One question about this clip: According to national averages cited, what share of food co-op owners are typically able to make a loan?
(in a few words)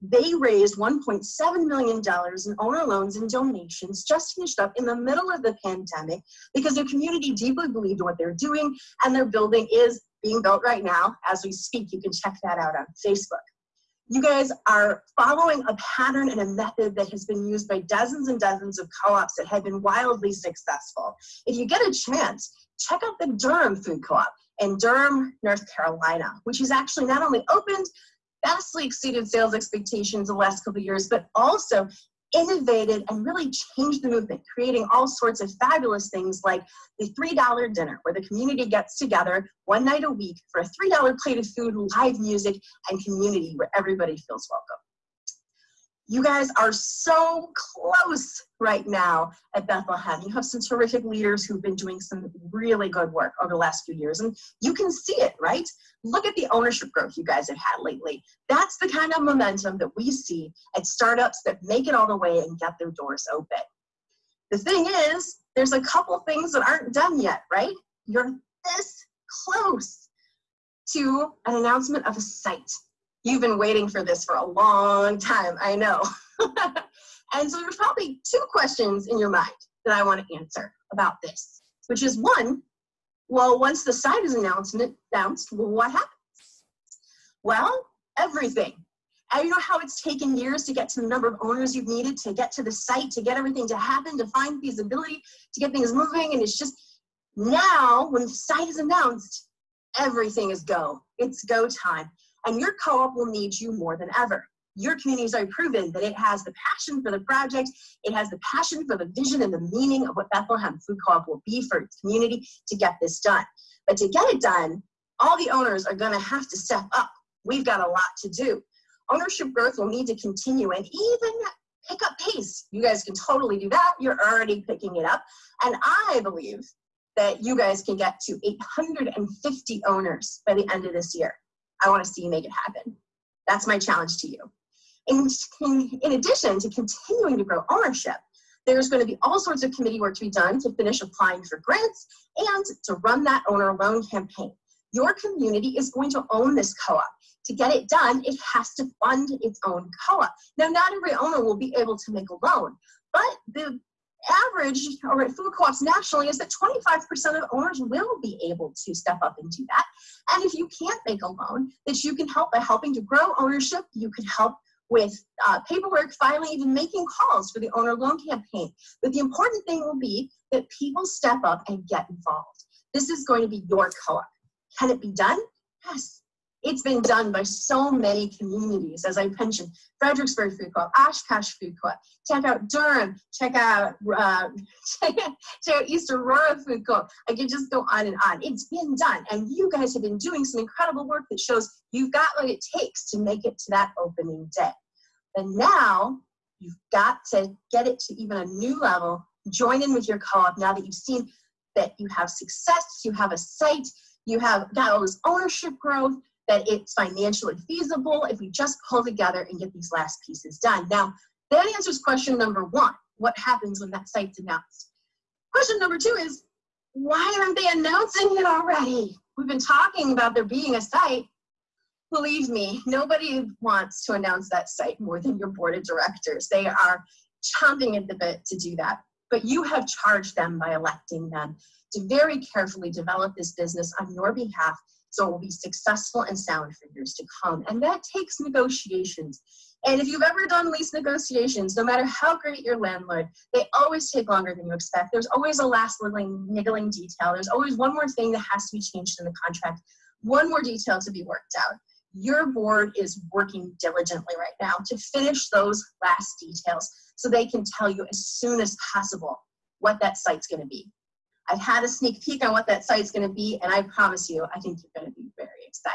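25%.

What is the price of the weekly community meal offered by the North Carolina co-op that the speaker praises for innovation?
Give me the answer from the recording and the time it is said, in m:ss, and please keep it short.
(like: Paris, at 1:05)
$3, at 0:37.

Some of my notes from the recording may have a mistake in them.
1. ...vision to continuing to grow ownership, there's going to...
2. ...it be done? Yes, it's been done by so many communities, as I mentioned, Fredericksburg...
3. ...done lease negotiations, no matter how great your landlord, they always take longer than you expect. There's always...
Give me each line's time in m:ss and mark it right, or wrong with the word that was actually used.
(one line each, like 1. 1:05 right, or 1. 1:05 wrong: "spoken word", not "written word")
1. 2:16 wrong: "addition", not "vision"
2. 2:54 right
3. 4:00 right.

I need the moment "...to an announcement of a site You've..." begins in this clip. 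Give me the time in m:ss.
1:10.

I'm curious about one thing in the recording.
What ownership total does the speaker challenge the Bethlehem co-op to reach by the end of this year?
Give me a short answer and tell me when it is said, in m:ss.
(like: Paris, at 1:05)
850, at 2:08.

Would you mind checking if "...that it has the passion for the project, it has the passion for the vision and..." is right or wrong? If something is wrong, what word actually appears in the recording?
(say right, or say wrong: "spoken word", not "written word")
right.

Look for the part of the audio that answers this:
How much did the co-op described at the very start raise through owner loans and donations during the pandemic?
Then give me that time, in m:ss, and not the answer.
0:00.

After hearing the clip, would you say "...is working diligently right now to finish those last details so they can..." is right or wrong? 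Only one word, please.
right.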